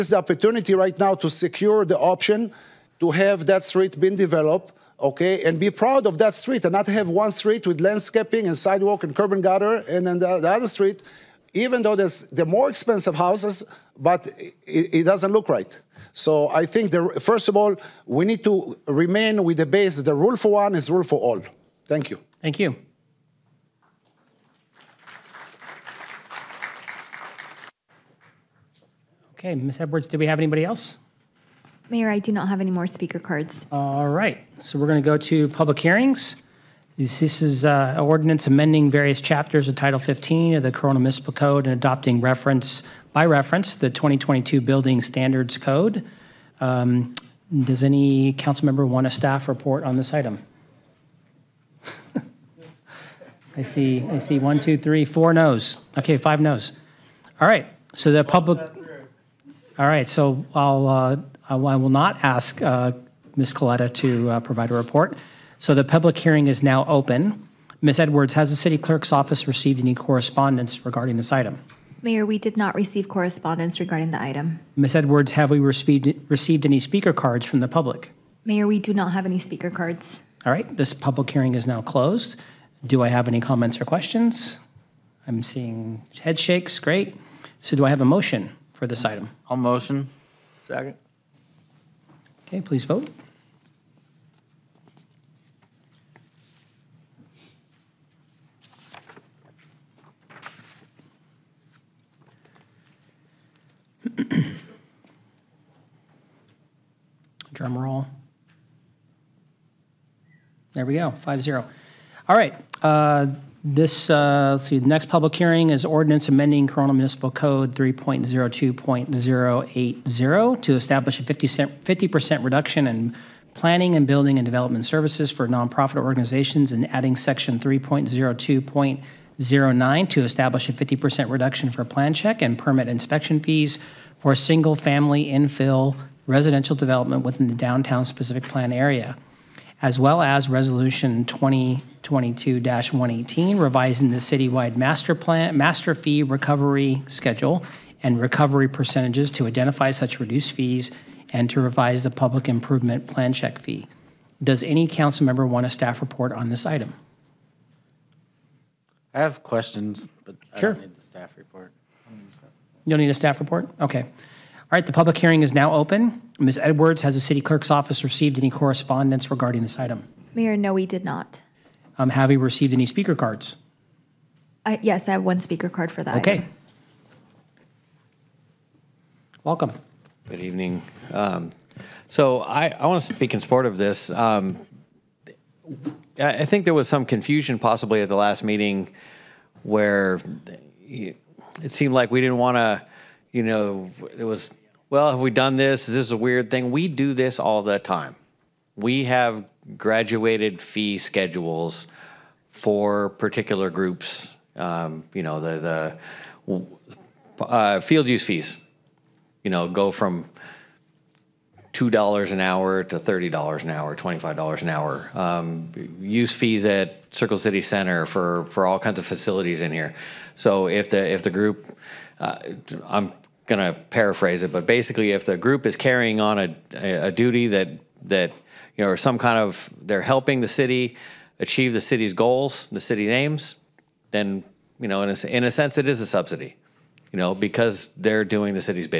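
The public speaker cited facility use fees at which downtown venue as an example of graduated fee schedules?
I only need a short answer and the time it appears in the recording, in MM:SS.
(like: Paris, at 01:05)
Circle City Center, at 03:37.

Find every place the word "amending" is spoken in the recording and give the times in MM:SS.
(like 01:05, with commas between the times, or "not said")
00:38, 01:56.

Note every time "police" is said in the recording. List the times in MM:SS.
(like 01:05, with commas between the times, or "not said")
not said.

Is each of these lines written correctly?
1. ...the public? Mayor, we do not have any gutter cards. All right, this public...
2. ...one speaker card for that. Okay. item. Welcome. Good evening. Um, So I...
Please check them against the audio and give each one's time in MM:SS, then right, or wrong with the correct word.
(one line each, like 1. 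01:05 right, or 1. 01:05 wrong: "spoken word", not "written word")
1. 01:17 wrong: "speaker", not "gutter"
2. 02:55 right.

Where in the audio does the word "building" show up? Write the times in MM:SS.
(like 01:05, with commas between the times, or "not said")
00:44, 02:04.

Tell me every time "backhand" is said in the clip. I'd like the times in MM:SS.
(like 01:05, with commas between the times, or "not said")
not said.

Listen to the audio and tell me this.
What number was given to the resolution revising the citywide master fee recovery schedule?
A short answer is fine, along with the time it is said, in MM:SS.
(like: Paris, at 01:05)
2022-118, at 02:20.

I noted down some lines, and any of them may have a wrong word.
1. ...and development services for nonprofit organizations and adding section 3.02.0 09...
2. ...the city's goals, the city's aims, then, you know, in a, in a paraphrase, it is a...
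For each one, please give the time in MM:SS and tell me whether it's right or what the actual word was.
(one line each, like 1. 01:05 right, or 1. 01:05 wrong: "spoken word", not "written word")
1. 02:04 right
2. 03:51 wrong: "sense", not "paraphrase".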